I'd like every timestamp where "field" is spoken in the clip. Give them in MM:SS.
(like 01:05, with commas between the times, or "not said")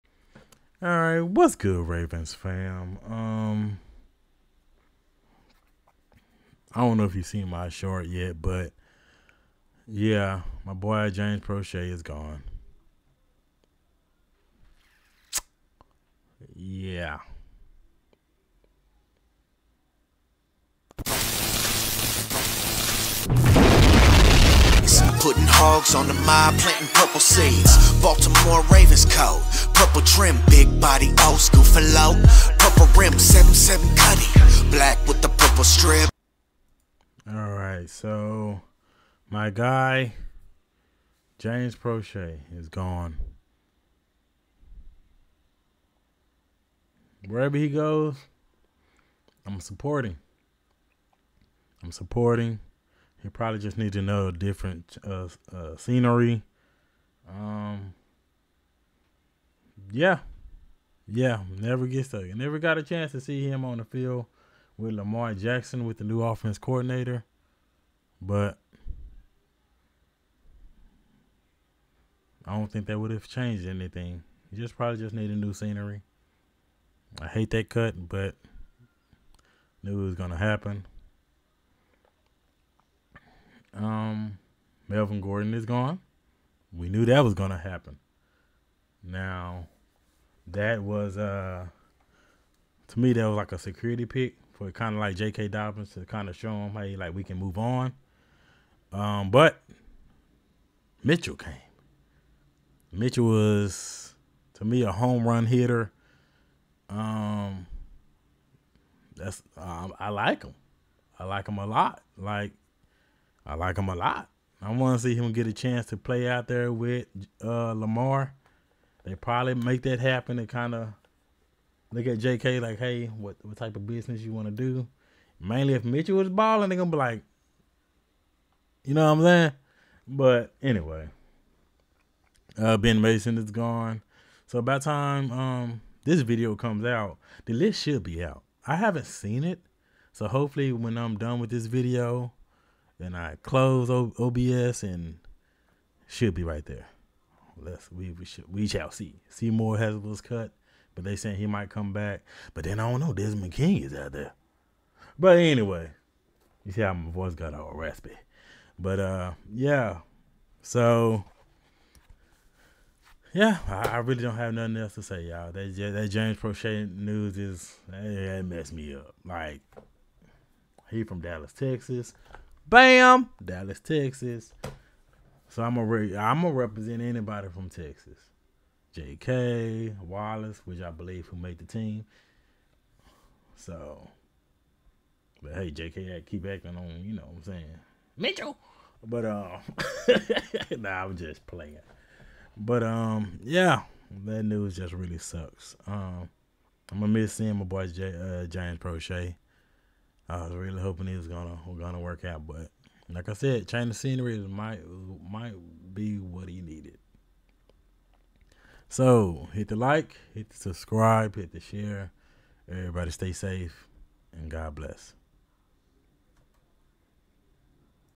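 01:03.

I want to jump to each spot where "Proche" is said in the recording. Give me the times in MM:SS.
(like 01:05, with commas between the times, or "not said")
00:11, 00:41, 02:46, 03:18.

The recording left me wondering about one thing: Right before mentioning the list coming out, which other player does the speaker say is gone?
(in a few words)
Ben Mason.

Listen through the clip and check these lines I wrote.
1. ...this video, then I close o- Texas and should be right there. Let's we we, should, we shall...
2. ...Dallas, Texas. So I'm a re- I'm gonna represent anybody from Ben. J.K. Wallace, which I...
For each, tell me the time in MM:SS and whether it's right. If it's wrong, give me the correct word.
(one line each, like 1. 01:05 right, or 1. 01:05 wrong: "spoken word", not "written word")
1. 02:21 wrong: "OBS", not "Texas"
2. 02:53 wrong: "Texas", not "Ben".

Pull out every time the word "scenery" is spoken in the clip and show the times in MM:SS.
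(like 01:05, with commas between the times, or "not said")
00:55, 01:15, 03:23.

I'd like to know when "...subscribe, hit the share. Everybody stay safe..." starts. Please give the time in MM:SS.
03:30.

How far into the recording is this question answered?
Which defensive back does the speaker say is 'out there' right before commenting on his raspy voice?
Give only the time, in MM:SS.
02:33.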